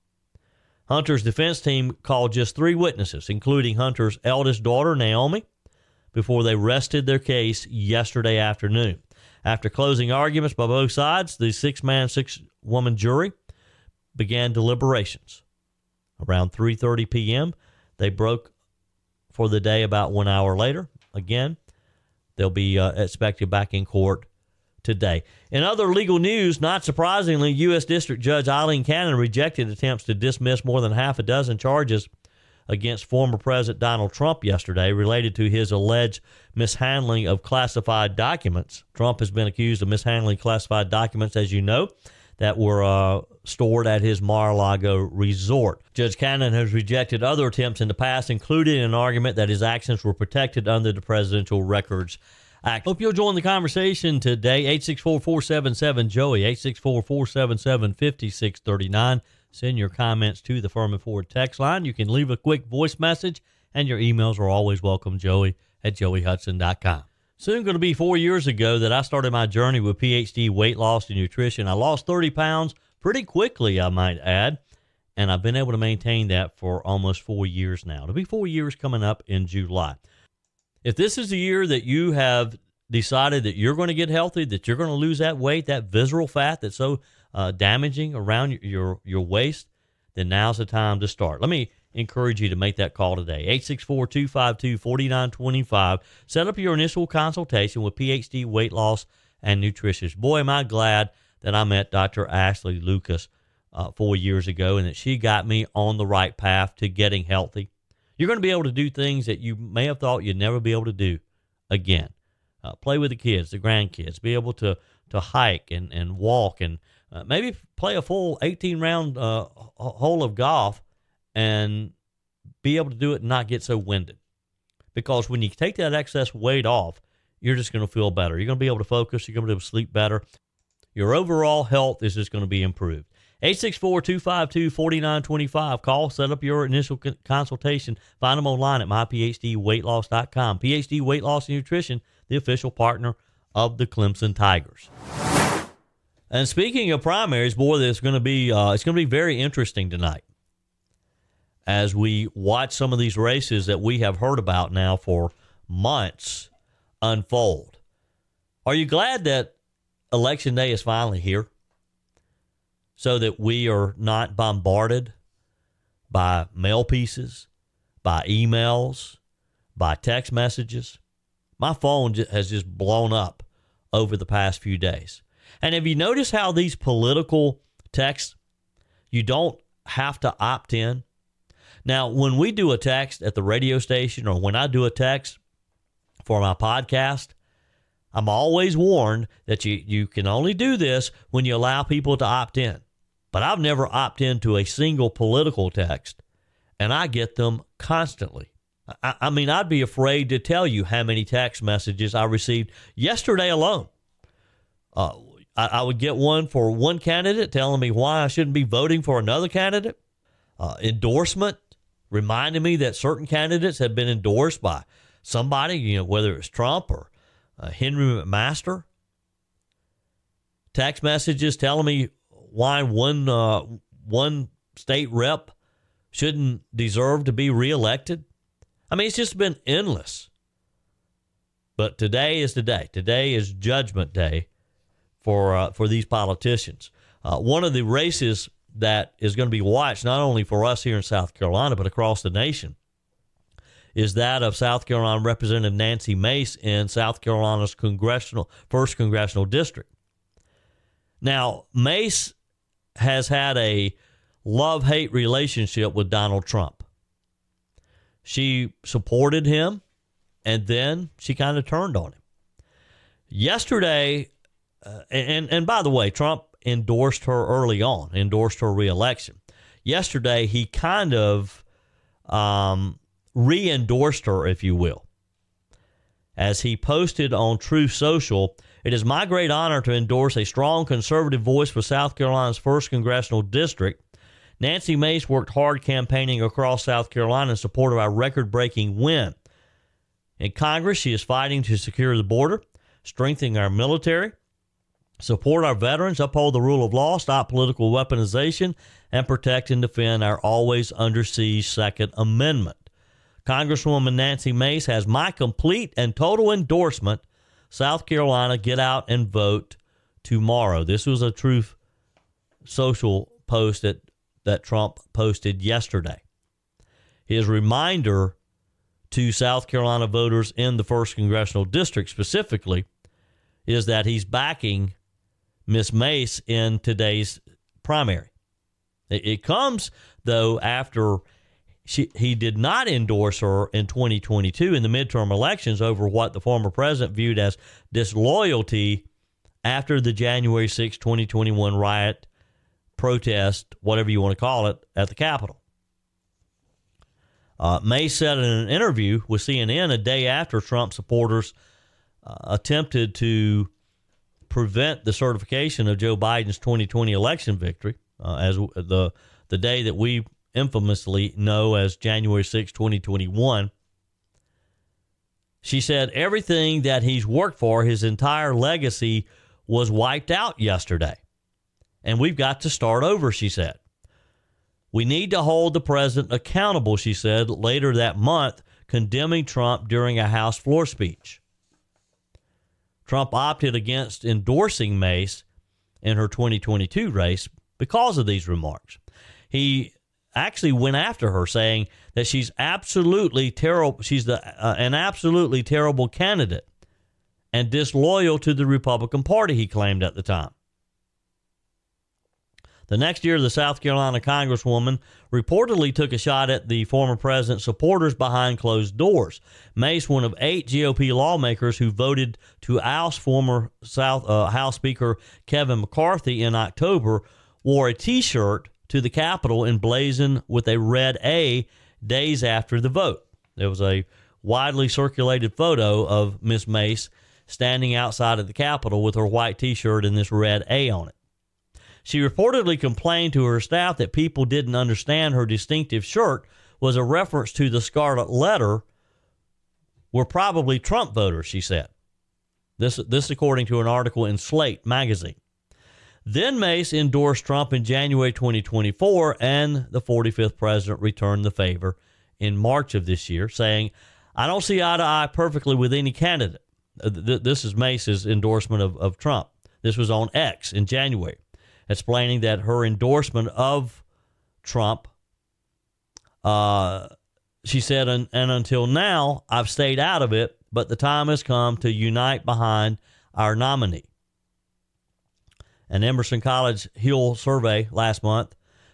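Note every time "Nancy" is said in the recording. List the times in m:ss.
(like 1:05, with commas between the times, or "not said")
4:05, 4:44, 5:04.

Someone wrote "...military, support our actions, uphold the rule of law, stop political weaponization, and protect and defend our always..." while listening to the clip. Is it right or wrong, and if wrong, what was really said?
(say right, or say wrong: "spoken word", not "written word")
wrong: "veterans", not "actions".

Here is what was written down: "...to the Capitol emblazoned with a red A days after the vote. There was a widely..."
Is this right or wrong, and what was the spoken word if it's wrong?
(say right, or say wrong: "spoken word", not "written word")
right.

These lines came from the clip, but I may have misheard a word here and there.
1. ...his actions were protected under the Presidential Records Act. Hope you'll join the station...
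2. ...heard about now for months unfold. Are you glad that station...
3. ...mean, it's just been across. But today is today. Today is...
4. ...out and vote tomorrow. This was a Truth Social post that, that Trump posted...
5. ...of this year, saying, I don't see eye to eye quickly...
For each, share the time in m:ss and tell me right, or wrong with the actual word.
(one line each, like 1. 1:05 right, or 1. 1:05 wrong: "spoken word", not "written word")
1. 0:49 wrong: "conversation", not "station"
2. 2:34 wrong: "election", not "station"
3. 3:48 wrong: "endless", not "across"
4. 5:08 right
5. 7:32 wrong: "perfectly", not "quickly".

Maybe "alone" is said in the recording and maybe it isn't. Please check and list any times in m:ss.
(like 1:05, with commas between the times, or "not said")
3:23.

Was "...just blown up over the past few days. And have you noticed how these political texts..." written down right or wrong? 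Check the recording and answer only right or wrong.
right.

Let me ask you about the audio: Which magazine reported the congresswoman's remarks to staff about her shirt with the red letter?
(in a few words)
Slate.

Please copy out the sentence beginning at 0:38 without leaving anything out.
Trump has been accused of mishandling classified documents, as you know, that were uh, stored at his Mar a Lago resort.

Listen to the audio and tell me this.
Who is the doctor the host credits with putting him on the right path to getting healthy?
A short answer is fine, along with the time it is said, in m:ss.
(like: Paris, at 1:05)
Dr. Ashley Lucas, at 1:41.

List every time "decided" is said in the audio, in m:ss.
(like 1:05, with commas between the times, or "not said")
1:22.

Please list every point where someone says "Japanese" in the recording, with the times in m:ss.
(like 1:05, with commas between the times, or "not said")
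not said.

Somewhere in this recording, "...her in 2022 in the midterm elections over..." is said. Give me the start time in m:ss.
5:33.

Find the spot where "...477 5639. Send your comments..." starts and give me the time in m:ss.
0:57.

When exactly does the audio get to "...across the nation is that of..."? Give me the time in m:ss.
4:01.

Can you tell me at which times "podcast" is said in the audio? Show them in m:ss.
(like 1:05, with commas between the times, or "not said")
3:06.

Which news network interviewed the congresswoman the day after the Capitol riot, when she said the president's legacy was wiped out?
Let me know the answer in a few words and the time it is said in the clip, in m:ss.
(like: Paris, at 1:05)
CNN, at 5:49.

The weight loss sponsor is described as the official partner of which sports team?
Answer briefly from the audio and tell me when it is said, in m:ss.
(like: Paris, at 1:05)
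Clemson Tigers, at 2:23.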